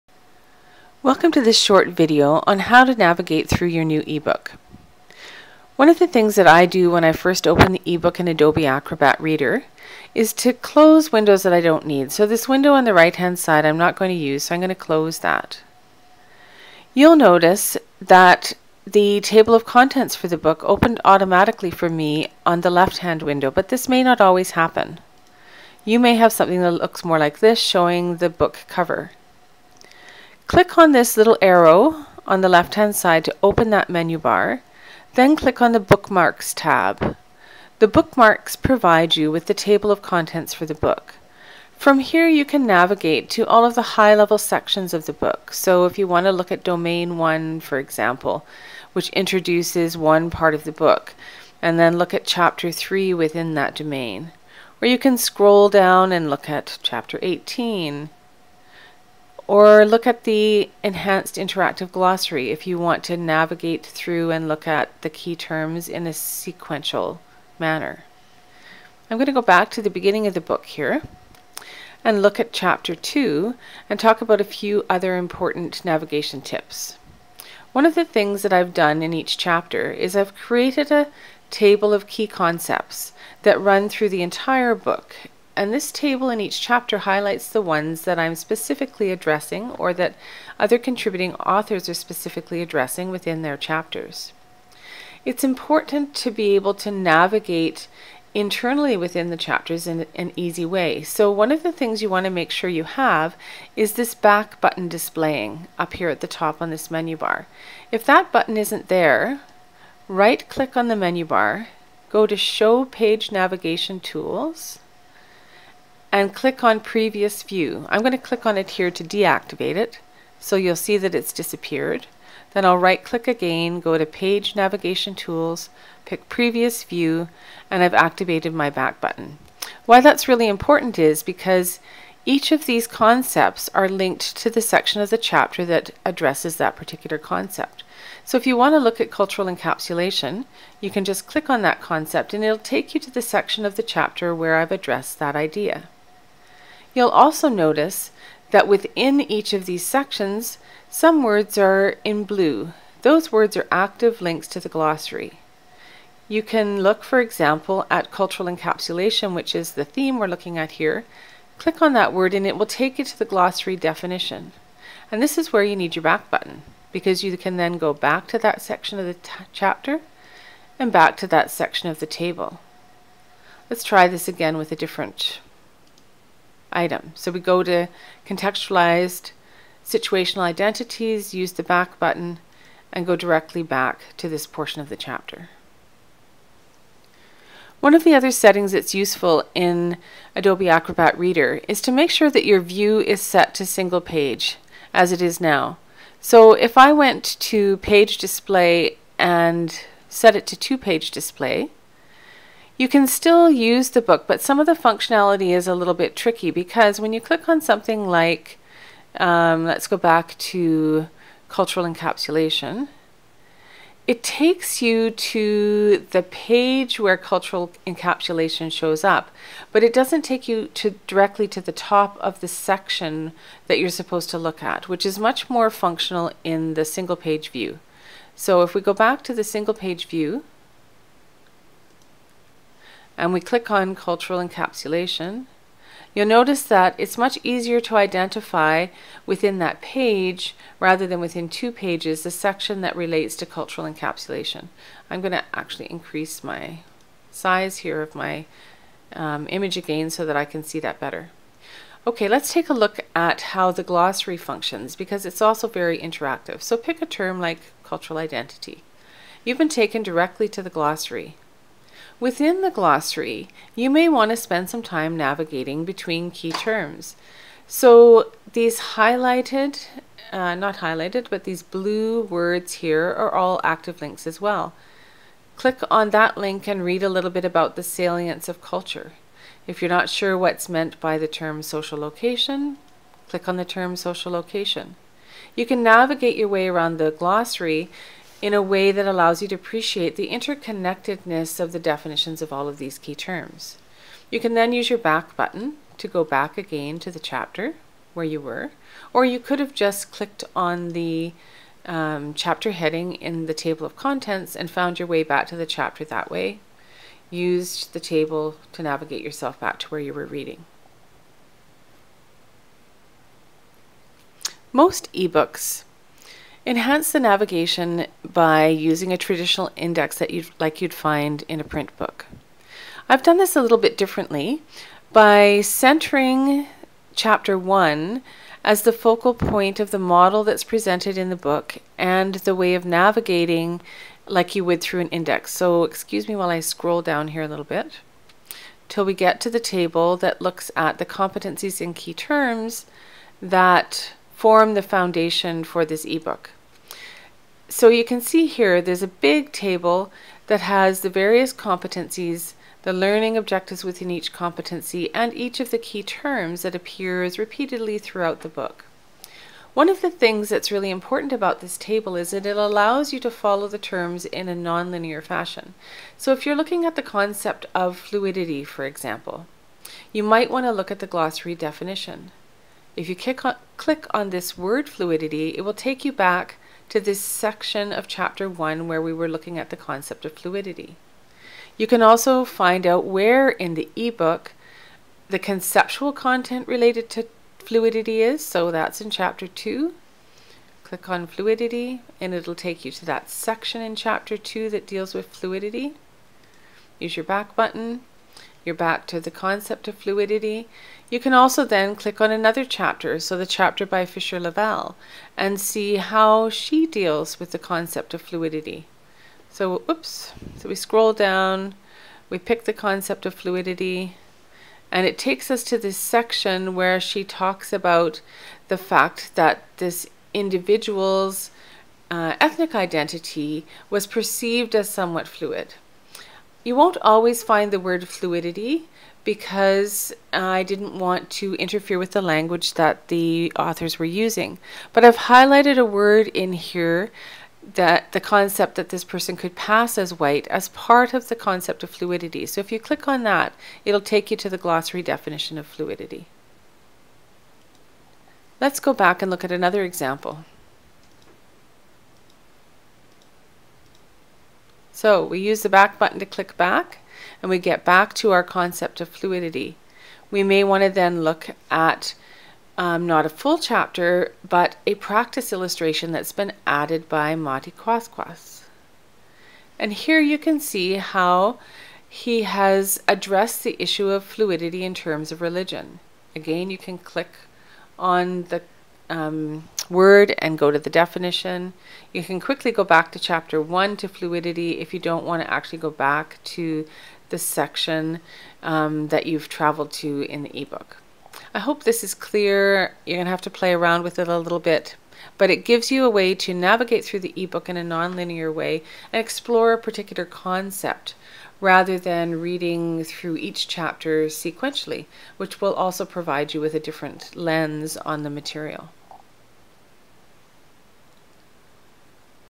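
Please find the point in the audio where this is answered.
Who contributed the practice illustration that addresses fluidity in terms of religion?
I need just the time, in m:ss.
7:47.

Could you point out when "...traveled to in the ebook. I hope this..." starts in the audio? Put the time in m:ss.
8:09.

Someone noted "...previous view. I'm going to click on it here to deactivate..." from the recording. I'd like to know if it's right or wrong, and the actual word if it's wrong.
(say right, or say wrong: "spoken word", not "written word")
right.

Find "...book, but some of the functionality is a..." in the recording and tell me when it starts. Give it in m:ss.
3:24.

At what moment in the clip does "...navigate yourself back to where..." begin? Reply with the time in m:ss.
5:08.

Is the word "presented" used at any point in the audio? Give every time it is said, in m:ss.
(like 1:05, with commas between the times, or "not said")
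5:30.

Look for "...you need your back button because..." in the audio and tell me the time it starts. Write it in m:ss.
2:45.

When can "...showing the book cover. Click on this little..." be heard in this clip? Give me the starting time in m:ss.
0:27.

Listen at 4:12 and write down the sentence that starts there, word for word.
Okay, let's take a look at how the glossary functions because it's also very interactive.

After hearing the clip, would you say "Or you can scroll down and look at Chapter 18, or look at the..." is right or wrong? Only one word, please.
right.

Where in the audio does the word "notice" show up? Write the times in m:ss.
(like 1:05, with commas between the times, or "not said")
0:17, 2:27, 3:56.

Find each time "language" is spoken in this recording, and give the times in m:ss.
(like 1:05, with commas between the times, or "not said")
7:12.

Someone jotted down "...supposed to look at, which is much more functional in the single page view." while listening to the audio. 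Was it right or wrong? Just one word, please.
right.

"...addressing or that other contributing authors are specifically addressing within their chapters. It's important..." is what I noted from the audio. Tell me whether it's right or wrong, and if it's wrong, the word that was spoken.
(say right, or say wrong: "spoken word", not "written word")
right.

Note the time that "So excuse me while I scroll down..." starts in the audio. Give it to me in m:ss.
5:35.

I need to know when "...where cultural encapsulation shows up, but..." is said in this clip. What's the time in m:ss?
3:36.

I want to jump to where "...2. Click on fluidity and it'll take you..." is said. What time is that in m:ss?
6:29.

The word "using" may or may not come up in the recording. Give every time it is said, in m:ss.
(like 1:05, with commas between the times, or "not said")
5:18, 7:14.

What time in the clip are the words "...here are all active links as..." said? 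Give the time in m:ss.
4:32.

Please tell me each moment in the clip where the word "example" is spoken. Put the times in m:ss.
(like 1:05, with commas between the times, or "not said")
0:47, 2:37, 6:08, 7:29.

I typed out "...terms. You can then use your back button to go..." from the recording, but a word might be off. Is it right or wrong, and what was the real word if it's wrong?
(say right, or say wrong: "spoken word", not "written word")
right.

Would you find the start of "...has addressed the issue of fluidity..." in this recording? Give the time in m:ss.
7:52.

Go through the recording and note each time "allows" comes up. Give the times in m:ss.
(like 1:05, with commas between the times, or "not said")
4:49, 6:02.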